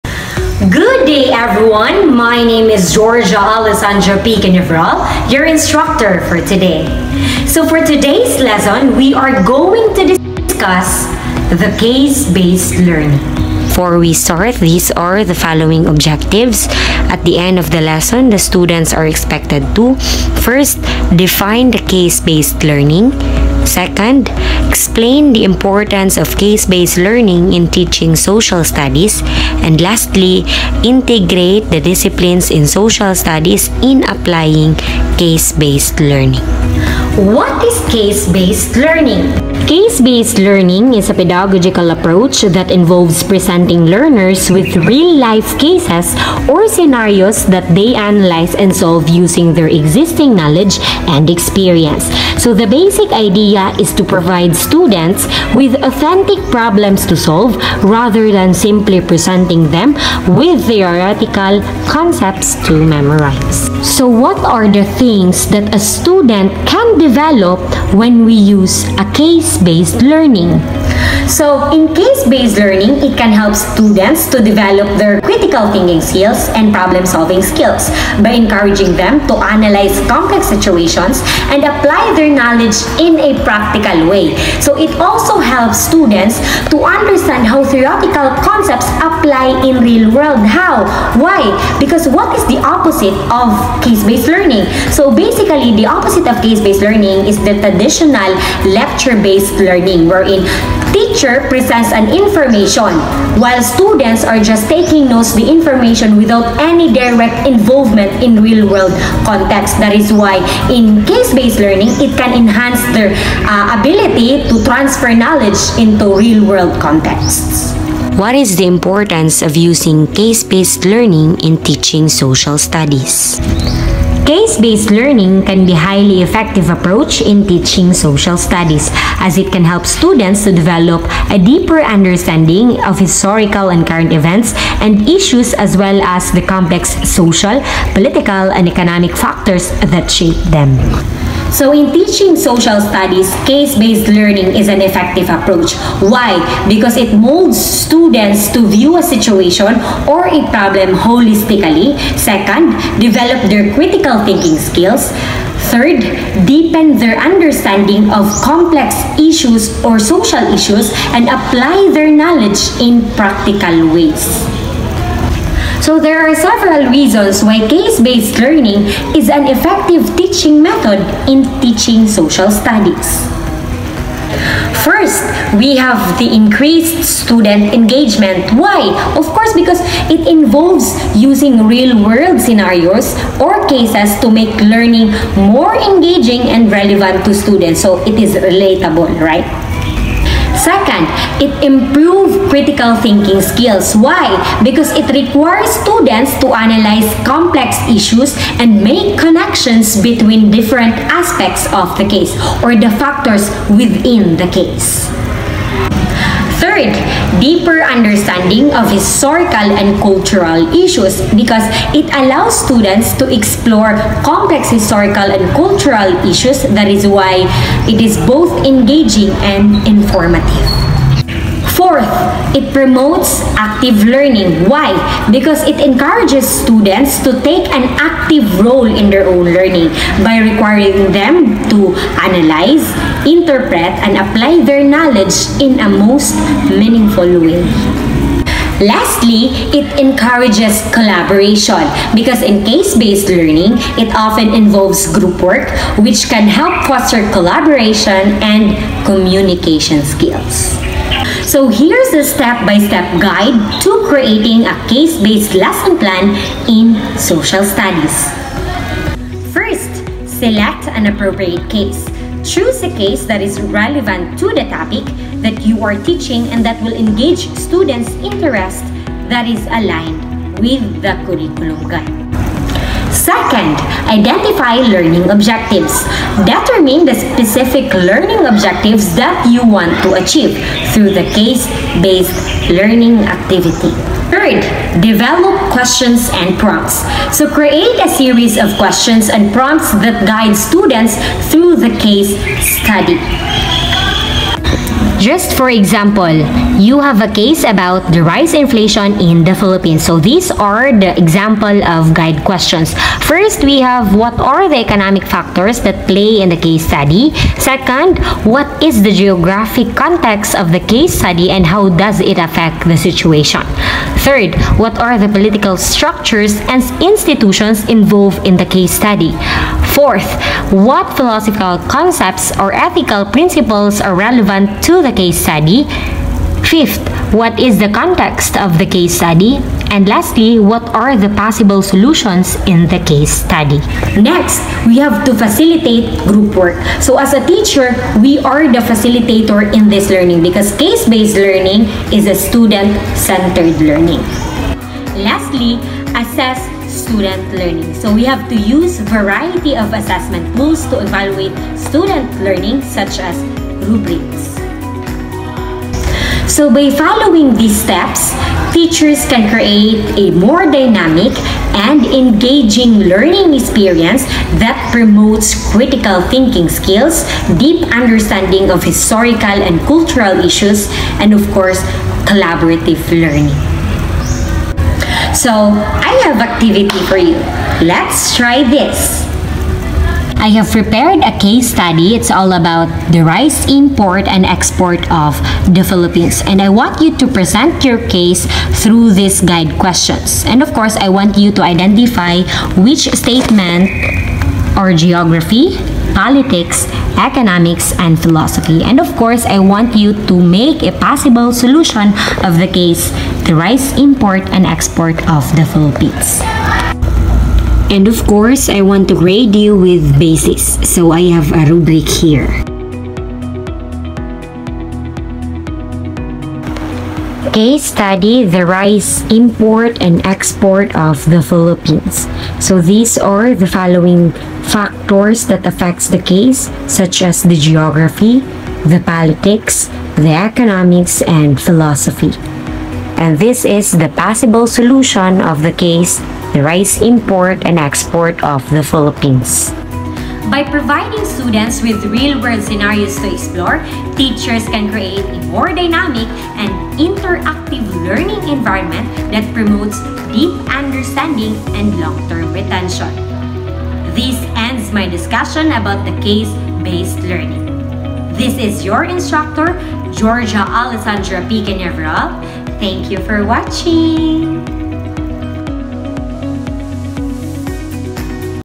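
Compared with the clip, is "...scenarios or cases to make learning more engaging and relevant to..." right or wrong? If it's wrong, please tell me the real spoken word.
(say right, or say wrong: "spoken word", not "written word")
right.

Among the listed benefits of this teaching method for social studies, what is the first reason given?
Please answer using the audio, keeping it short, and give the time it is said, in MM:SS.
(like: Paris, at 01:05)
Increased student engagement, at 02:56.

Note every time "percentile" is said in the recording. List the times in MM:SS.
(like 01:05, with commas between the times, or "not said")
not said.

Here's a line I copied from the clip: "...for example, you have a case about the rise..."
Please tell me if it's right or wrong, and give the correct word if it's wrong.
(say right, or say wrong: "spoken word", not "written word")
right.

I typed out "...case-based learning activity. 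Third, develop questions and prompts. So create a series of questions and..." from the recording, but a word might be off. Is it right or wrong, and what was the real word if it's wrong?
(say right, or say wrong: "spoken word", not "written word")
right.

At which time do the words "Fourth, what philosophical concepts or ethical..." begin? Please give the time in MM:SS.
05:19.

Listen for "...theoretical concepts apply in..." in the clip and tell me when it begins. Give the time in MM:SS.
01:27.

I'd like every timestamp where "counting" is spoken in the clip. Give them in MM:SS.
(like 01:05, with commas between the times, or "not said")
not said.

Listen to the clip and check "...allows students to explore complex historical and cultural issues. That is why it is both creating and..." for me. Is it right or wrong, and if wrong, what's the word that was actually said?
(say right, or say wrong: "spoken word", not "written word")
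wrong: "engaging", not "creating".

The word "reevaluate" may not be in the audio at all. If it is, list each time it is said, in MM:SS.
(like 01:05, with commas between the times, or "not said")
not said.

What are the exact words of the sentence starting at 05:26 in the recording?
Fifth, what is the context of the case study?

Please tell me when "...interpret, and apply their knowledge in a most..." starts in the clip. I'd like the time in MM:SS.
03:53.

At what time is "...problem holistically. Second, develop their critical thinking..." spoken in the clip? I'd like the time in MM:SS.
02:30.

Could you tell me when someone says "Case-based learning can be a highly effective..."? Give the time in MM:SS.
02:04.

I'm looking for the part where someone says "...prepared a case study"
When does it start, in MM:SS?
06:20.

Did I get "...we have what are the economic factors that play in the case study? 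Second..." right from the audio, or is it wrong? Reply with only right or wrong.
right.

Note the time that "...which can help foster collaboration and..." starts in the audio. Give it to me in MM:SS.
04:05.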